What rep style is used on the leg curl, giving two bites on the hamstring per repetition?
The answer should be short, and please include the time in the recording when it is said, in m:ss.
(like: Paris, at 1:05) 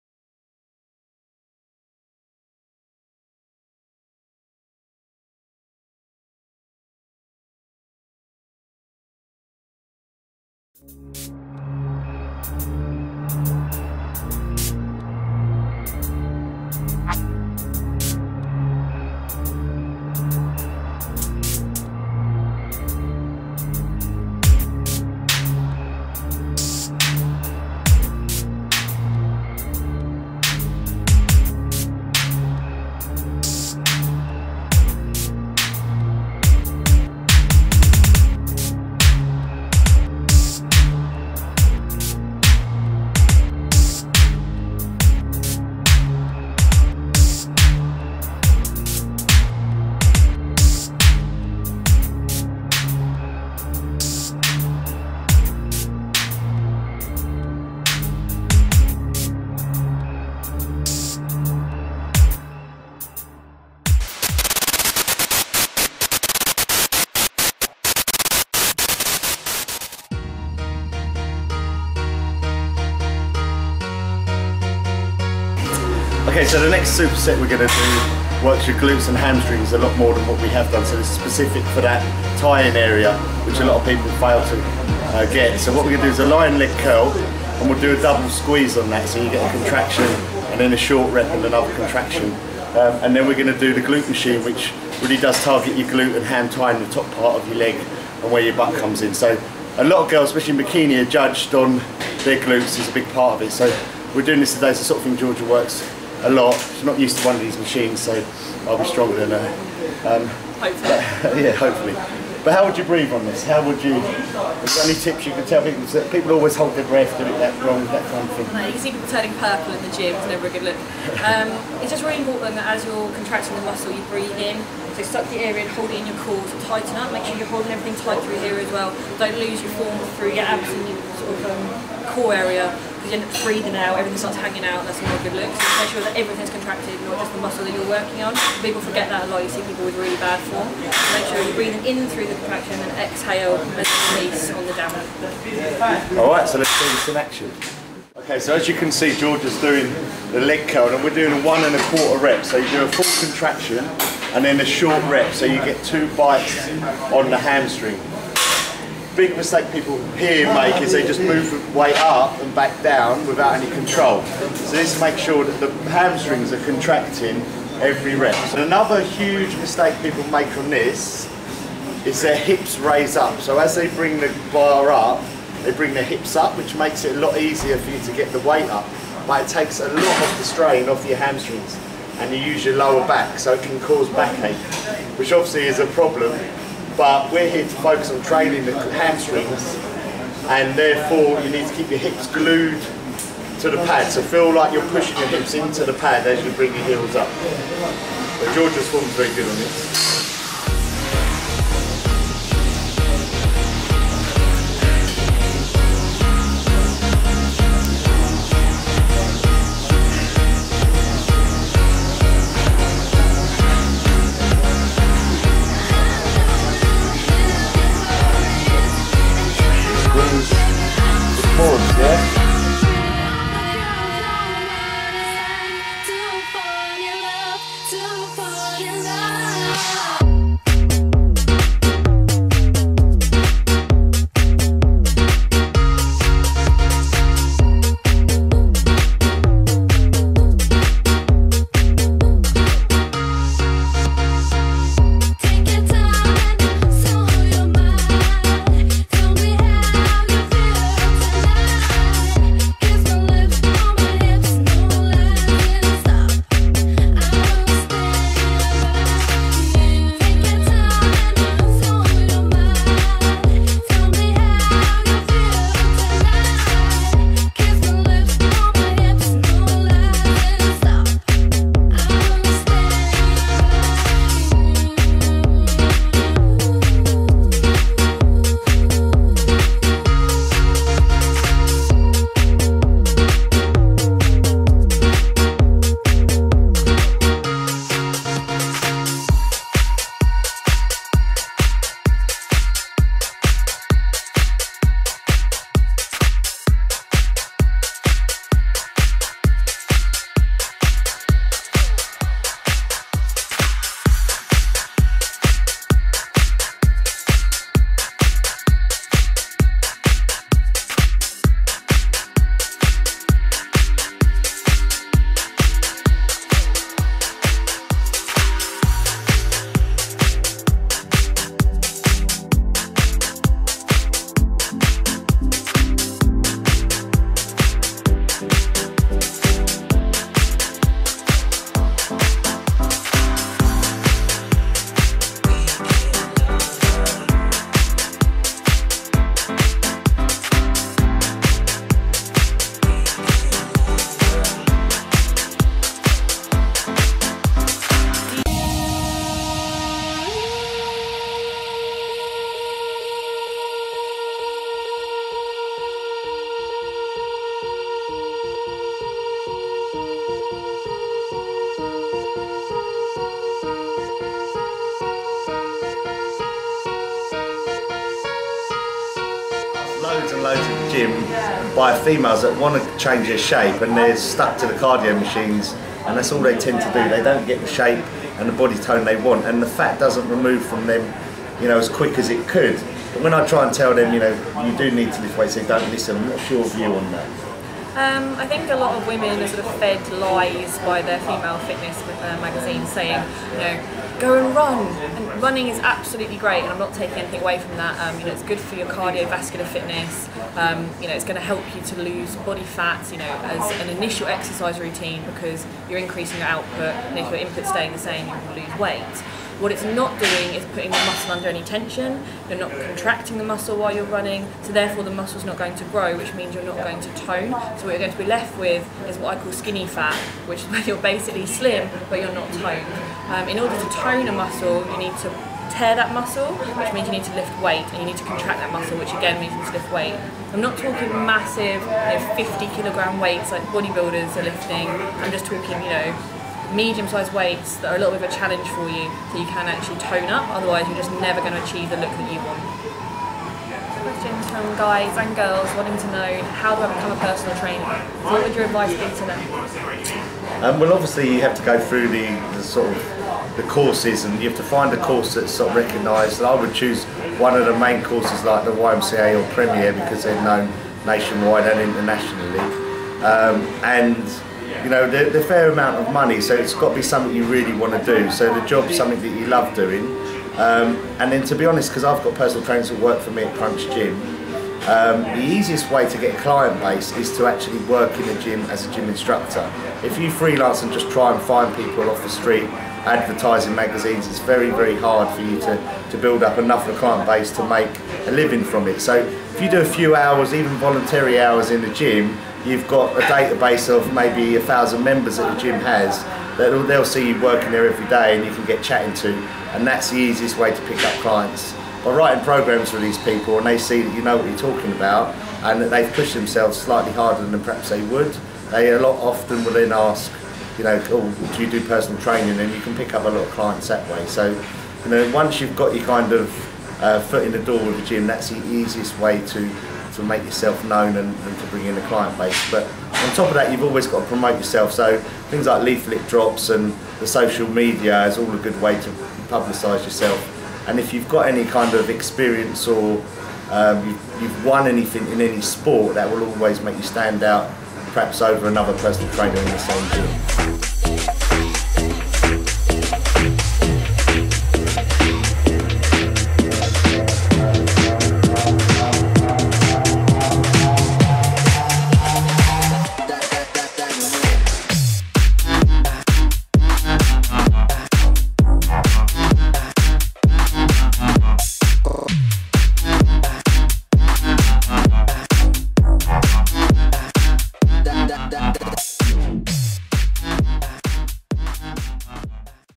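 one and a quarter rep, at 2:31.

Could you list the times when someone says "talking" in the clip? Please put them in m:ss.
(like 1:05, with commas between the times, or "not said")
7:10, 7:15, 8:24.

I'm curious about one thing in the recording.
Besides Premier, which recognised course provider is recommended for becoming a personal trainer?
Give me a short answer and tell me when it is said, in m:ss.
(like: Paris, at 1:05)
YMCA, at 7:38.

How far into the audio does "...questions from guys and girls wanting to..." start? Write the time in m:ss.
7:24.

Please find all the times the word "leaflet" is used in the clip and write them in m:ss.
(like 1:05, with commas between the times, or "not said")
8:45.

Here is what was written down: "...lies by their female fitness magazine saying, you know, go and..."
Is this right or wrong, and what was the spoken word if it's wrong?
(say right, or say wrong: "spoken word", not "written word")
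right.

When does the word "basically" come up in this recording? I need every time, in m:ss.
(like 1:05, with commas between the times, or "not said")
7:00.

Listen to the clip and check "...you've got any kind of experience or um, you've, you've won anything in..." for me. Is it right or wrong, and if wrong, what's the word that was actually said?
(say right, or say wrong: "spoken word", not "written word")
right.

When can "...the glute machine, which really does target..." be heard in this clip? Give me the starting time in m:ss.
1:33.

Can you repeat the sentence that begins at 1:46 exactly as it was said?
She's not used to one of these machines, so I'll be stronger than her.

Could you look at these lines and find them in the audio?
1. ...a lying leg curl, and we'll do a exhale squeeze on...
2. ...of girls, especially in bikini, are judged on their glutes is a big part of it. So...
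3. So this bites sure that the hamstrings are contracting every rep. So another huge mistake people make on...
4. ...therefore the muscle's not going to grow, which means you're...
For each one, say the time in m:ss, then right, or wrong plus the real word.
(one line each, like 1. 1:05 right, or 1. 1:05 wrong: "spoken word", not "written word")
1. 1:26 wrong: "double", not "exhale"
2. 1:40 right
3. 2:44 wrong: "makes", not "bites"
4. 6:54 right.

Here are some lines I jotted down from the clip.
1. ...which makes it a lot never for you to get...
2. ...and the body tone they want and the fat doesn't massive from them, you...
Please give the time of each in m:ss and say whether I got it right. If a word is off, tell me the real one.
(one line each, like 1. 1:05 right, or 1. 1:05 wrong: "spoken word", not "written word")
1. 2:56 wrong: "easier", not "never"
2. 6:18 wrong: "remove", not "massive".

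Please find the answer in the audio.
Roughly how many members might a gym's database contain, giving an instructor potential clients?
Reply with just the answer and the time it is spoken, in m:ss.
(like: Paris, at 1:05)
1000, at 8:14.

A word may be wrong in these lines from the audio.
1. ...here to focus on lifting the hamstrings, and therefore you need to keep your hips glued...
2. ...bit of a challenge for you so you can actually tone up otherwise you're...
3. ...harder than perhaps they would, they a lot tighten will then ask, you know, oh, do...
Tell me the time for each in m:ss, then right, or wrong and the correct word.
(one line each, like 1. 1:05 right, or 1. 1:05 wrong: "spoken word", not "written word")
1. 3:07 wrong: "training", not "lifting"
2. 7:18 right
3. 8:27 wrong: "often", not "tighten".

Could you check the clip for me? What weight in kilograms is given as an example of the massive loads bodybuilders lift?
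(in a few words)
50.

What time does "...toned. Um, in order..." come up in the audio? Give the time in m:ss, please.
7:02.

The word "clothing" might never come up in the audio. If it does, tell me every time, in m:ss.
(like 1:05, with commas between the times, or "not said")
not said.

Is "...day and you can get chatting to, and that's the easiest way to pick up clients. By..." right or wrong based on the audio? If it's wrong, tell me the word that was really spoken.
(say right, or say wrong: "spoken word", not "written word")
right.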